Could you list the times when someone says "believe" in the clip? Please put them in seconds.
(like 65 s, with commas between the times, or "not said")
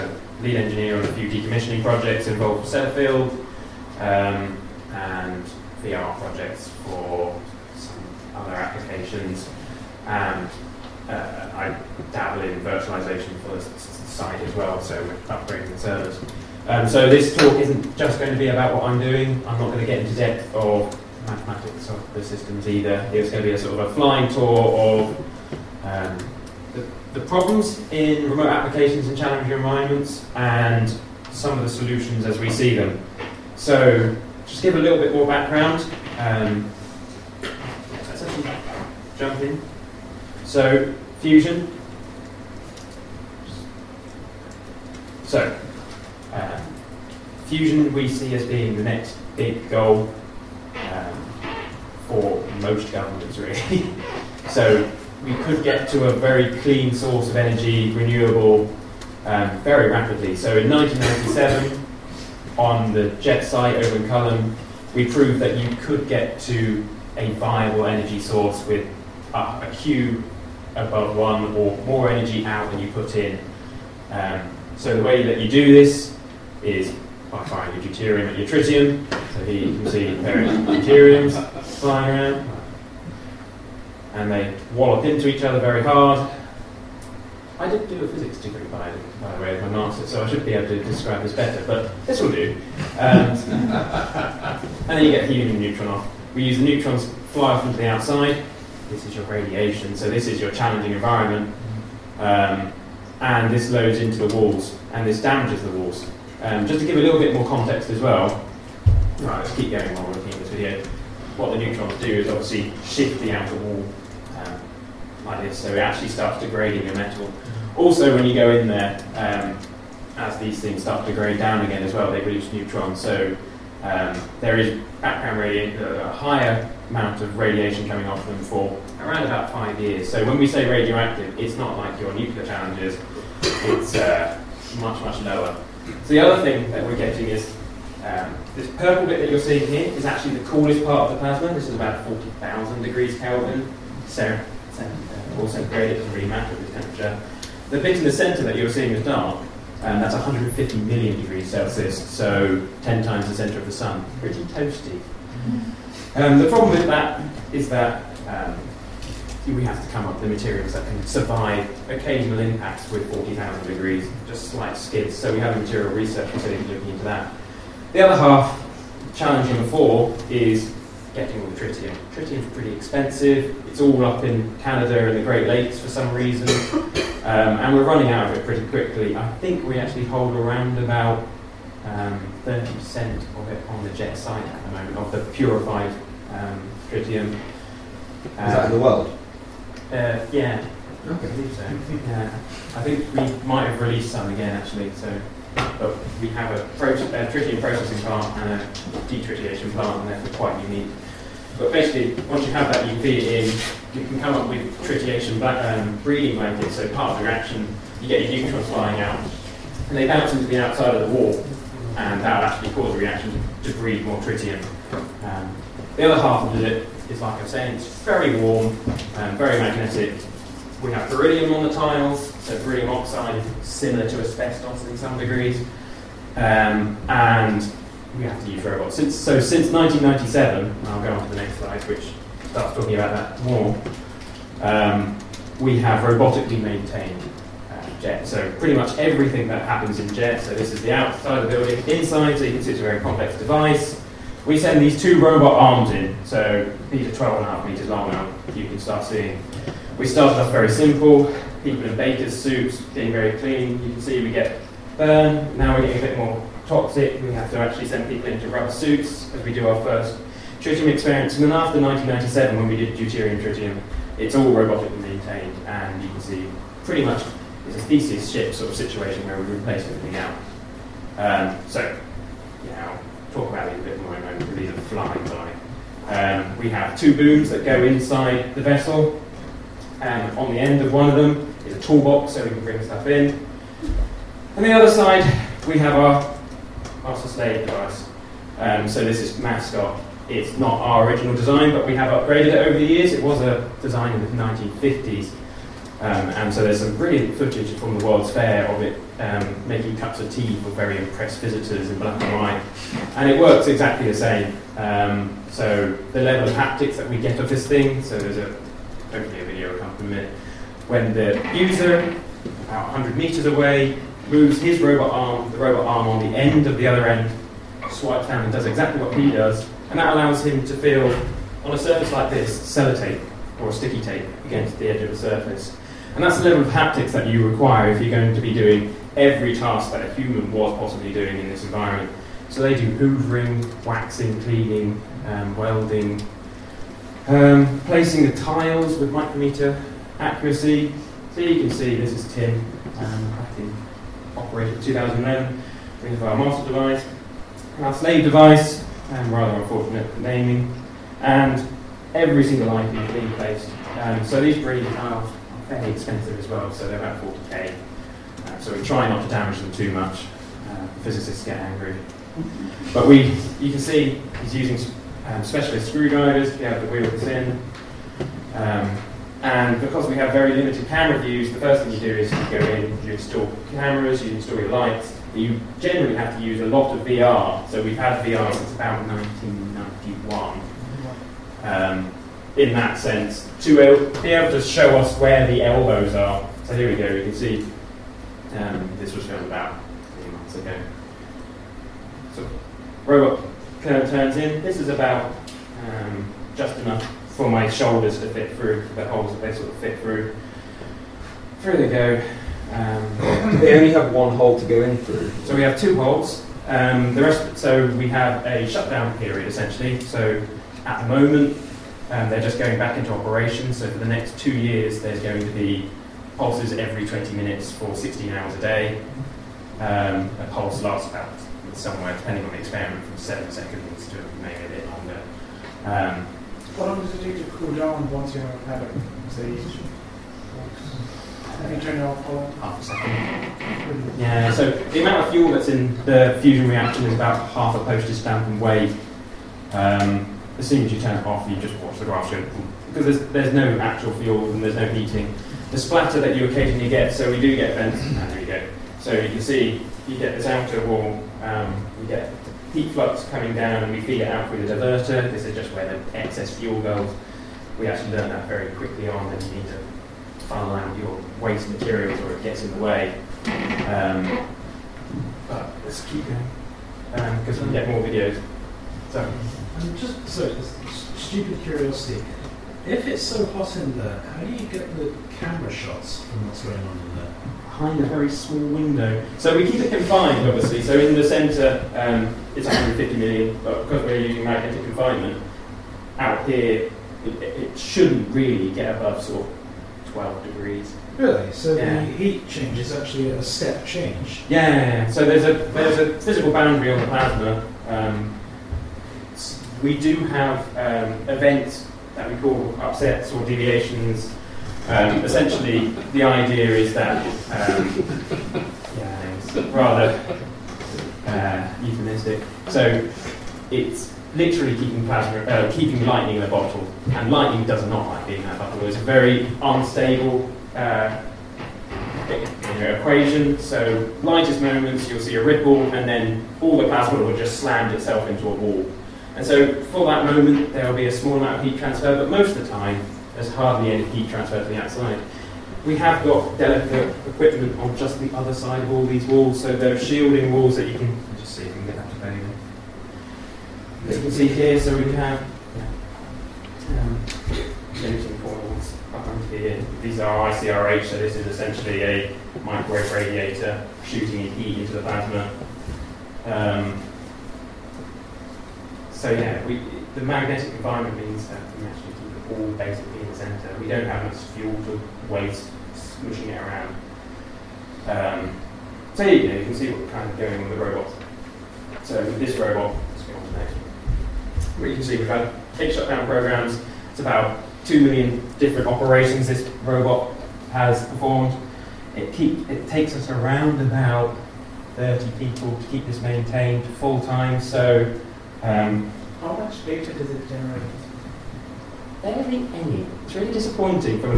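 191 s.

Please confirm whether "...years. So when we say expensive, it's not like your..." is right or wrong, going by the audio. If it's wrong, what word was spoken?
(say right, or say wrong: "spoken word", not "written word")
wrong: "radioactive", not "expensive".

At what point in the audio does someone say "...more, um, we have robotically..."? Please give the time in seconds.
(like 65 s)
233 s.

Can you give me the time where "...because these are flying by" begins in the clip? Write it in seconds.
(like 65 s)
274 s.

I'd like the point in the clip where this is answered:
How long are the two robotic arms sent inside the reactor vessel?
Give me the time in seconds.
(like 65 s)
247 s.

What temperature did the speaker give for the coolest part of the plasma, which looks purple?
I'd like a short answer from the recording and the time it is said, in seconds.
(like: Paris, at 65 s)
40,000 degrees Kelvin, at 142 s.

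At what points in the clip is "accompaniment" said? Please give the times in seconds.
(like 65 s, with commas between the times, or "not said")
309 s.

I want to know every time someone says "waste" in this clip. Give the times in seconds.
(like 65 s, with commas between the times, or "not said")
461 s, 565 s.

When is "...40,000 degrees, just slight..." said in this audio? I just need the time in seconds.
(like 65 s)
163 s.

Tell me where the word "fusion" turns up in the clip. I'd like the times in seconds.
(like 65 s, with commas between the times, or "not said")
41 s, 47 s, 436 s.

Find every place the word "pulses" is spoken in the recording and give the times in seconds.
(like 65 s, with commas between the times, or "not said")
416 s, 420 s.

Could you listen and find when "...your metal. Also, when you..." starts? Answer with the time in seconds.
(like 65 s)
116 s.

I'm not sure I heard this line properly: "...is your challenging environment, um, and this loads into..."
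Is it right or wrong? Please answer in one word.
right.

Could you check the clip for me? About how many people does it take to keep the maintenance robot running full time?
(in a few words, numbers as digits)
30.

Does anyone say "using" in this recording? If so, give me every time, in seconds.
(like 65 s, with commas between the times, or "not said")
364 s, 484 s.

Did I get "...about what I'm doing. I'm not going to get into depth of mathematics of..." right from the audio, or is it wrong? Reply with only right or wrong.
right.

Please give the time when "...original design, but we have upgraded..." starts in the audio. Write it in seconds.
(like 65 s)
291 s.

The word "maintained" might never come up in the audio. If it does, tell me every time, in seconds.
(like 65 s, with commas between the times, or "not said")
236 s, 265 s, 586 s.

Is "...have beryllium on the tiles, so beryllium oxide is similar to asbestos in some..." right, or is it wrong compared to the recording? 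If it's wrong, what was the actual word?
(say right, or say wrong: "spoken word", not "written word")
right.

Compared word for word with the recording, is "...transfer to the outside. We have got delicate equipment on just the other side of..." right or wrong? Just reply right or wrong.
right.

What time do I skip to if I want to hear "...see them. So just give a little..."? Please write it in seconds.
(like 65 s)
32 s.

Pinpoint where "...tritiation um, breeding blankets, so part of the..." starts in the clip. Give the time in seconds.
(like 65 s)
204 s.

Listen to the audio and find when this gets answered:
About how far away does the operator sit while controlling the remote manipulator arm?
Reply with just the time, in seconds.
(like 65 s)
312 s.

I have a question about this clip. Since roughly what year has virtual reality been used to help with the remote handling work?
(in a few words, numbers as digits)
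1991.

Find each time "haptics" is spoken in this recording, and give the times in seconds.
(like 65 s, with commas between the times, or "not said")
306 s, 326 s.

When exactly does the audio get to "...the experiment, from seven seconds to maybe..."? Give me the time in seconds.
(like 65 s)
422 s.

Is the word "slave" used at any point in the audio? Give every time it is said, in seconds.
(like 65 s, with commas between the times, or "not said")
287 s, 347 s.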